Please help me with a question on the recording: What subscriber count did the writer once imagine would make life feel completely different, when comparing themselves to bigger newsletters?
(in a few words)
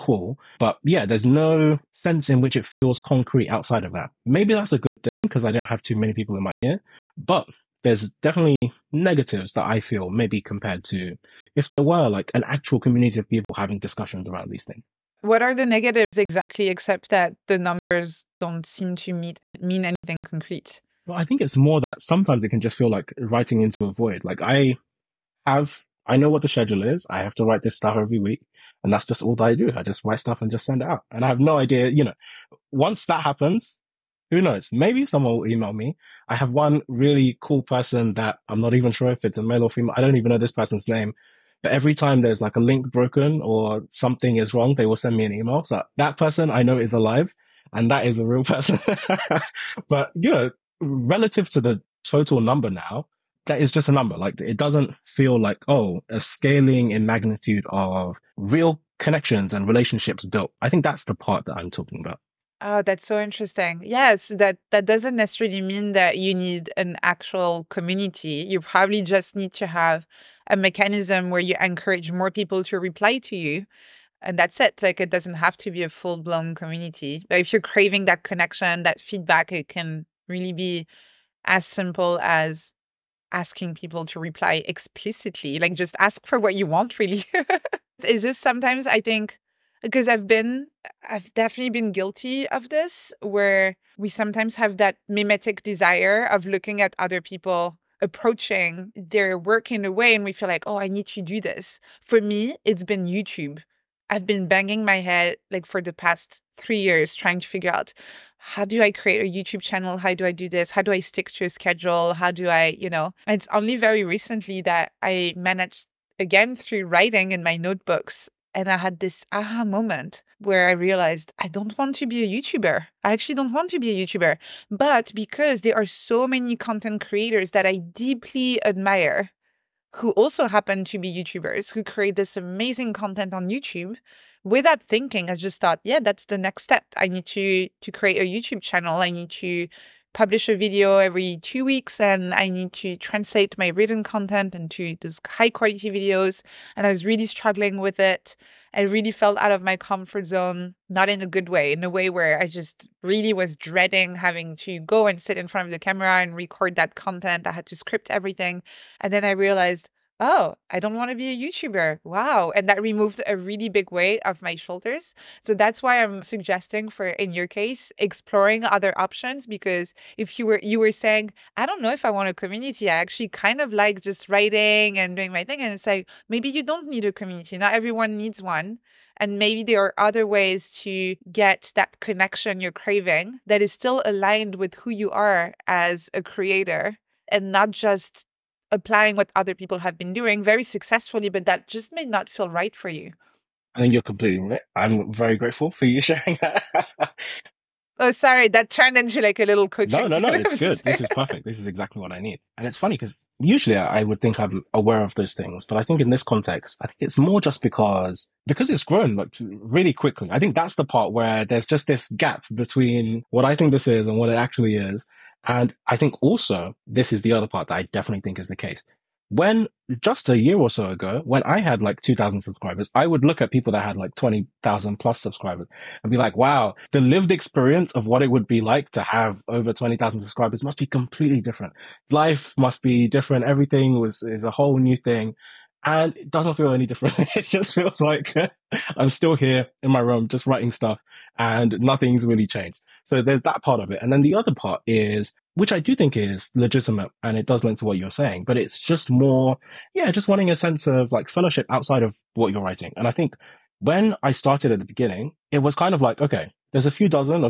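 20,000.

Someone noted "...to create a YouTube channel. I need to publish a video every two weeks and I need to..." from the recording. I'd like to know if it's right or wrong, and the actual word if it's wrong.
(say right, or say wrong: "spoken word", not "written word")
right.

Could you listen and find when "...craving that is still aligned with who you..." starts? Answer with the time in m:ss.
3:02.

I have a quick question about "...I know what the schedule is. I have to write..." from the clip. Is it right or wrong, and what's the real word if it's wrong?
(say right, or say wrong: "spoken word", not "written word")
right.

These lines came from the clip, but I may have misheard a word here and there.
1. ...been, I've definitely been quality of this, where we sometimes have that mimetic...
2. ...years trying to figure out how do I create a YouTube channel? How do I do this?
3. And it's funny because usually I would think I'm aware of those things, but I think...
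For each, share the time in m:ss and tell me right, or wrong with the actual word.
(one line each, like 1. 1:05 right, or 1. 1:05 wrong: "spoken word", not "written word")
1. 1:30 wrong: "guilty", not "quality"
2. 1:46 right
3. 3:22 right.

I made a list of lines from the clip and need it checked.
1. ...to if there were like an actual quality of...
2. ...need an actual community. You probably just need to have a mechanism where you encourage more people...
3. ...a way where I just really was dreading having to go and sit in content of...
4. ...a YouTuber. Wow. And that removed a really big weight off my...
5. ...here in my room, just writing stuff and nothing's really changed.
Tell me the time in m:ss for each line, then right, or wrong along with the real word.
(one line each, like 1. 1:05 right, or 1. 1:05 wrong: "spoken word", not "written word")
1. 0:10 wrong: "community", not "quality"
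2. 1:06 right
3. 2:31 wrong: "front", not "content"
4. 2:41 right
5. 3:59 right.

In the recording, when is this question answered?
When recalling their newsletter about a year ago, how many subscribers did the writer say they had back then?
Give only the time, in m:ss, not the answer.
3:42.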